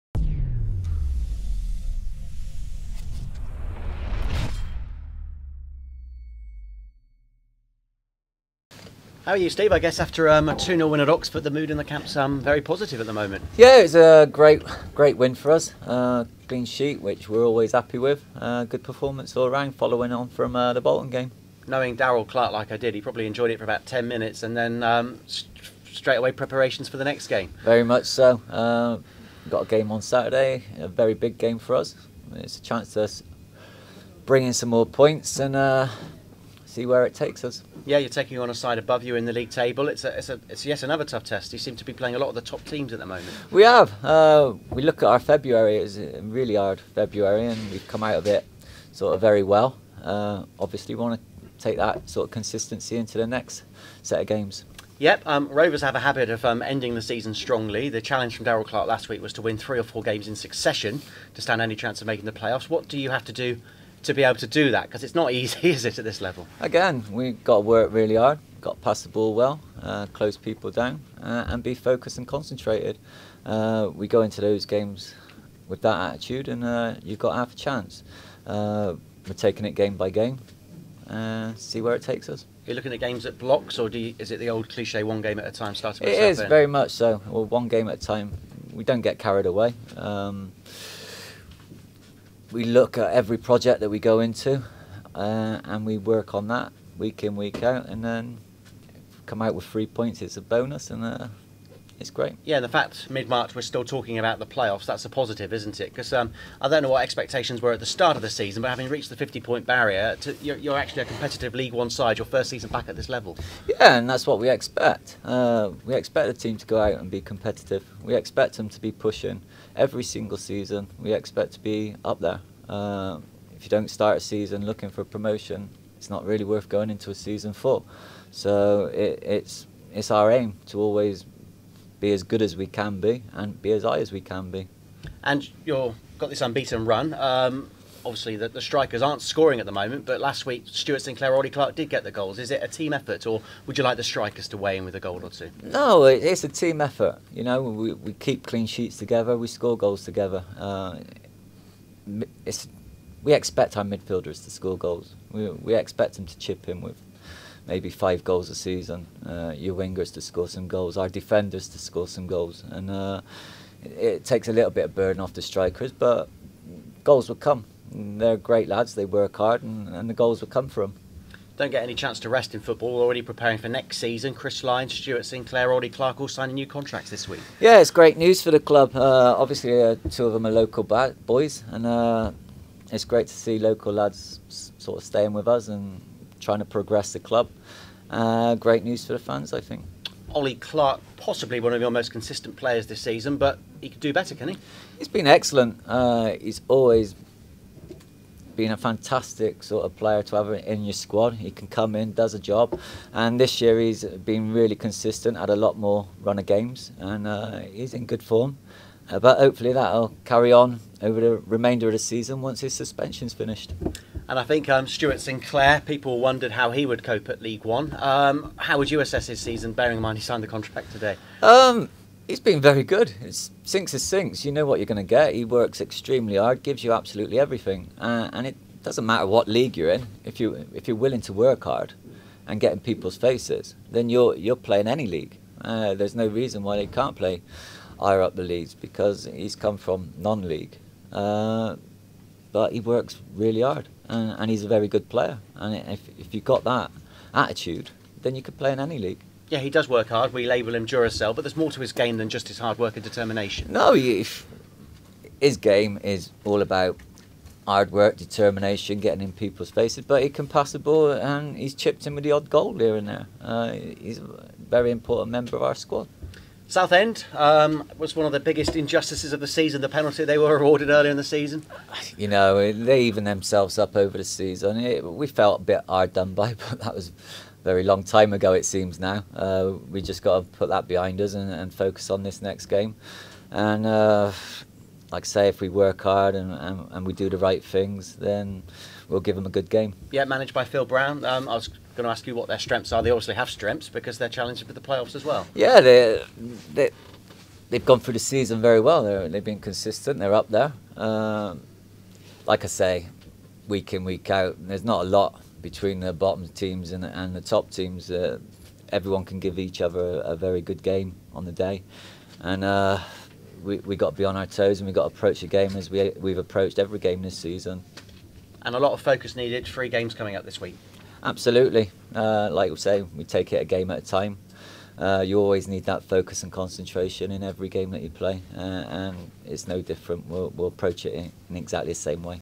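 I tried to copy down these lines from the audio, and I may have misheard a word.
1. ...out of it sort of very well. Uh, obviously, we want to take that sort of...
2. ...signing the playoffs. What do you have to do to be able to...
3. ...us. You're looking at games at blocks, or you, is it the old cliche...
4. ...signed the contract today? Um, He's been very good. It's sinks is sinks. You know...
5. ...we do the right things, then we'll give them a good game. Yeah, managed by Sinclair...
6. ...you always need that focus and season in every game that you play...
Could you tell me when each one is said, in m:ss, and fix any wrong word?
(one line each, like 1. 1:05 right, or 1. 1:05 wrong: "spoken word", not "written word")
1. 0:48 right
2. 1:02 wrong: "making", not "signing"
3. 1:22 right
4. 3:40 right
5. 4:47 wrong: "Phil", not "Sinclair"
6. 5:25 wrong: "concentration", not "season".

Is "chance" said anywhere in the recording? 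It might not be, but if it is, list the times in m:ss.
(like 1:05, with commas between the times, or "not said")
0:32, 1:01, 1:17, 2:51.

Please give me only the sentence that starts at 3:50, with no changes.
If you if you're willing to work hard and get in people's faces, then you're you're playing any league.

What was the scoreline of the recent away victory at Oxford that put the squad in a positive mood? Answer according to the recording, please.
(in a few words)
2-0.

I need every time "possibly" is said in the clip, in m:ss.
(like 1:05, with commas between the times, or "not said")
3:11.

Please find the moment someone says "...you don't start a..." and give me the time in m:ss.
2:03.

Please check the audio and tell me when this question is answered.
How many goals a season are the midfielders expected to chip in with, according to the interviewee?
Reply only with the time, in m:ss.
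2:37.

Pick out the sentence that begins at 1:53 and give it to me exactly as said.
Yeah, and that's what we expect.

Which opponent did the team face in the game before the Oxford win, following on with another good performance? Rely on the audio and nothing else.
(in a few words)
Bolton.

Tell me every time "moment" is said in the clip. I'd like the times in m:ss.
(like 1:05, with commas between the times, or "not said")
0:13, 0:43, 2:19.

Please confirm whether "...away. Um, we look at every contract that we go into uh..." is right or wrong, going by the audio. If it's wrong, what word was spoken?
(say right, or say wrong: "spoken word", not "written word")
wrong: "project", not "contract".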